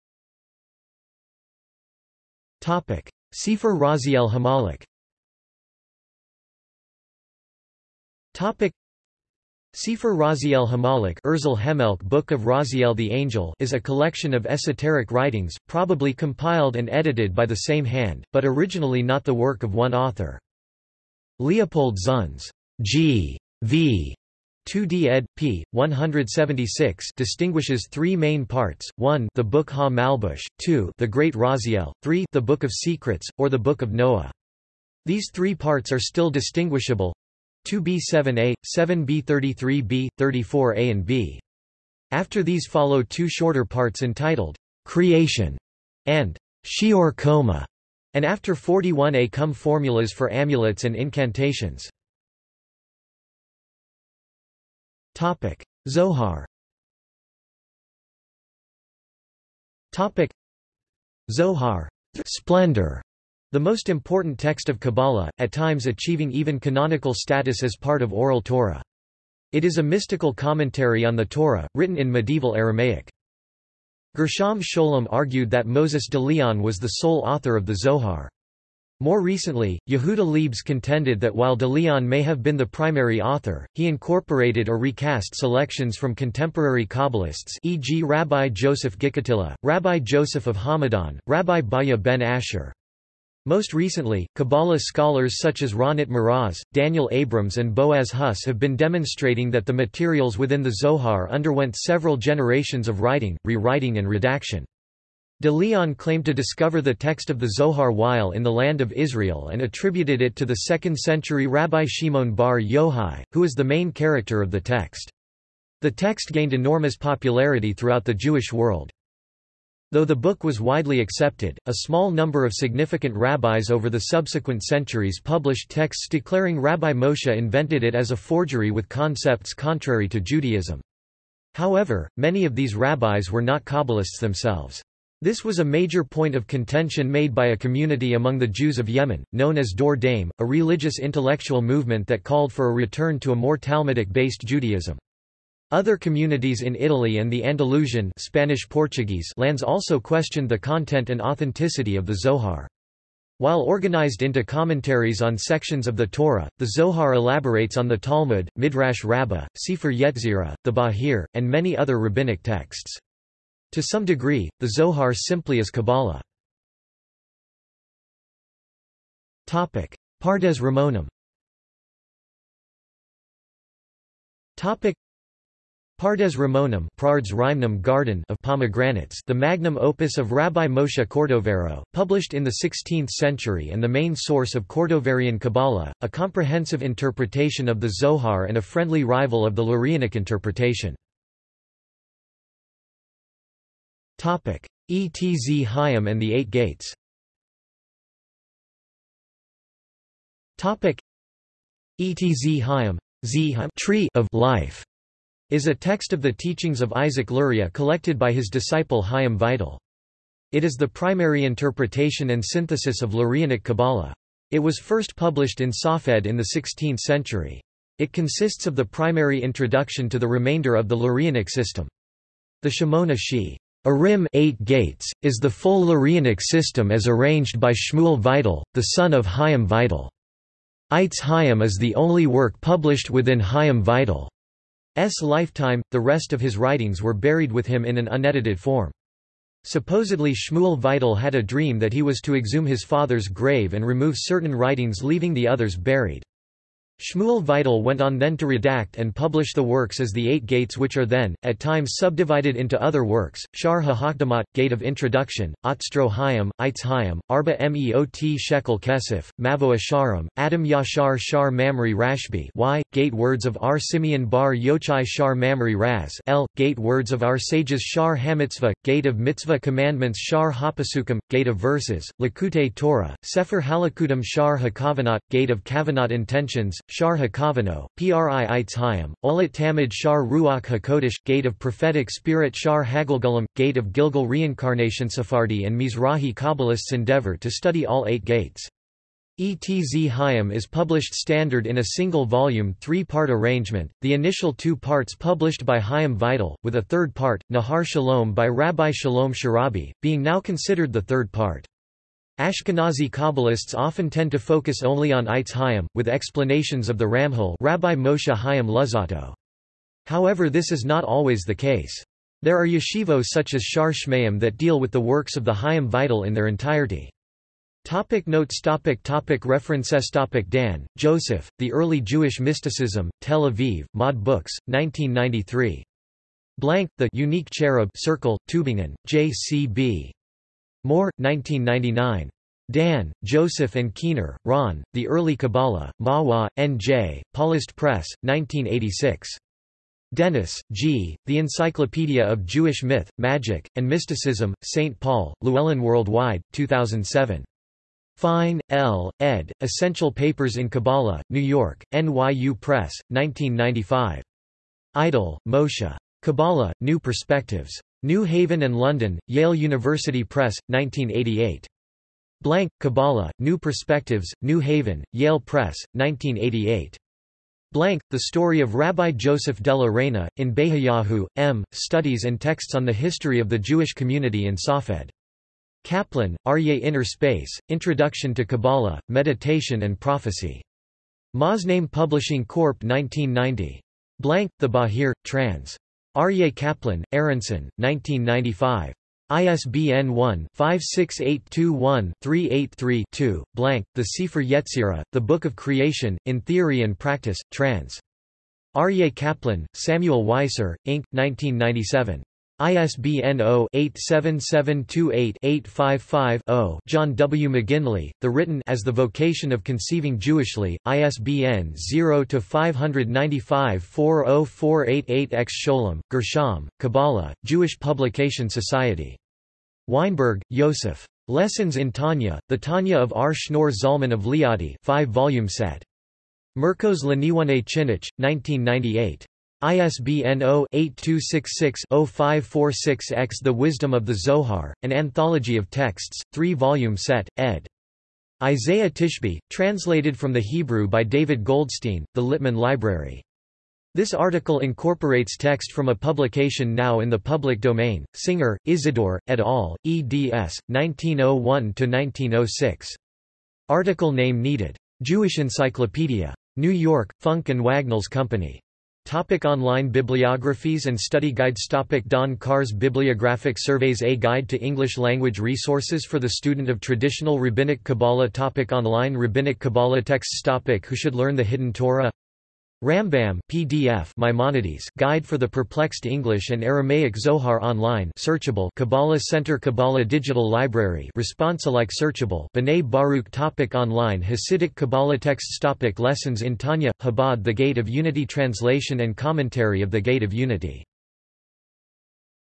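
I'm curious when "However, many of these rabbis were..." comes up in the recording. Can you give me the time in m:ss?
2:11.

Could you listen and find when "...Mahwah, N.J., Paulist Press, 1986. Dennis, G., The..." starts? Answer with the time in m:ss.
5:36.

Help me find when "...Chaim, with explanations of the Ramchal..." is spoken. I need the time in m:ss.
5:05.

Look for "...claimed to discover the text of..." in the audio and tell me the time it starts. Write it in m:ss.
1:45.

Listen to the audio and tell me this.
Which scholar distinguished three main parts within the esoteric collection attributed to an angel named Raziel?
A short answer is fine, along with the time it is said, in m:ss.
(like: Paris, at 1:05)
Leopold Zunz, at 0:21.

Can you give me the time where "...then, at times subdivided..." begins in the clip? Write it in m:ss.
4:11.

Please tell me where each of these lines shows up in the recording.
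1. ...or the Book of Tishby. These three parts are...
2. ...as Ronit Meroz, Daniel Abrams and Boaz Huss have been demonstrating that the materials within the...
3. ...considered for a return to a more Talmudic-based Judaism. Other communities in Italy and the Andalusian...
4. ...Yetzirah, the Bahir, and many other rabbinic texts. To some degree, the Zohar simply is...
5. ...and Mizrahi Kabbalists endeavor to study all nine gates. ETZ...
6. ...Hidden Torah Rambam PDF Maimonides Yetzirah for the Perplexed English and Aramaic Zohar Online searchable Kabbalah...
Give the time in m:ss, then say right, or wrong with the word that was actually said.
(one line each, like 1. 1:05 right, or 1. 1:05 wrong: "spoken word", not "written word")
1. 0:33 wrong: "Noah", not "Tishby"
2. 1:35 right
3. 2:22 wrong: "called", not "considered"
4. 2:39 right
5. 4:45 wrong: "eight", not "nine"
6. 7:51 wrong: "Guide", not "Yetzirah".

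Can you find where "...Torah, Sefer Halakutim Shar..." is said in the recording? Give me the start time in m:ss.
4:32.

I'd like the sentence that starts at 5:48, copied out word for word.
Fine, L., ed., Essential Papers in Kabbalah, New York, NYU Press, 1995.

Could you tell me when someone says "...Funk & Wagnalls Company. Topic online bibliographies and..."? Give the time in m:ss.
7:37.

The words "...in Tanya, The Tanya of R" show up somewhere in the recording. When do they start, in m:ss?
7:01.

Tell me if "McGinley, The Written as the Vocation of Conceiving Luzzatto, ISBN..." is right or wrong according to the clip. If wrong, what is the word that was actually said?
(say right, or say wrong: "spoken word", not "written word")
wrong: "Jewishly", not "Luzzatto".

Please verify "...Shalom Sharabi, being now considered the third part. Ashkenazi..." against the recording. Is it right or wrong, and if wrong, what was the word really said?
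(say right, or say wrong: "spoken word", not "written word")
right.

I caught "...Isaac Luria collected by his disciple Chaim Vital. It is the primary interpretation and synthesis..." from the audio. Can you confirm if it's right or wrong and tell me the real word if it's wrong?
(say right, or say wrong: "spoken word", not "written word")
right.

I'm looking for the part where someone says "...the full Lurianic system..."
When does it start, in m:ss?
3:45.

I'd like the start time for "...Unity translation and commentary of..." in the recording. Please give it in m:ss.
8:07.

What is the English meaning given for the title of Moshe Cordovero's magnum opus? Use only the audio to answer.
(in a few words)
Garden of Pomegranates.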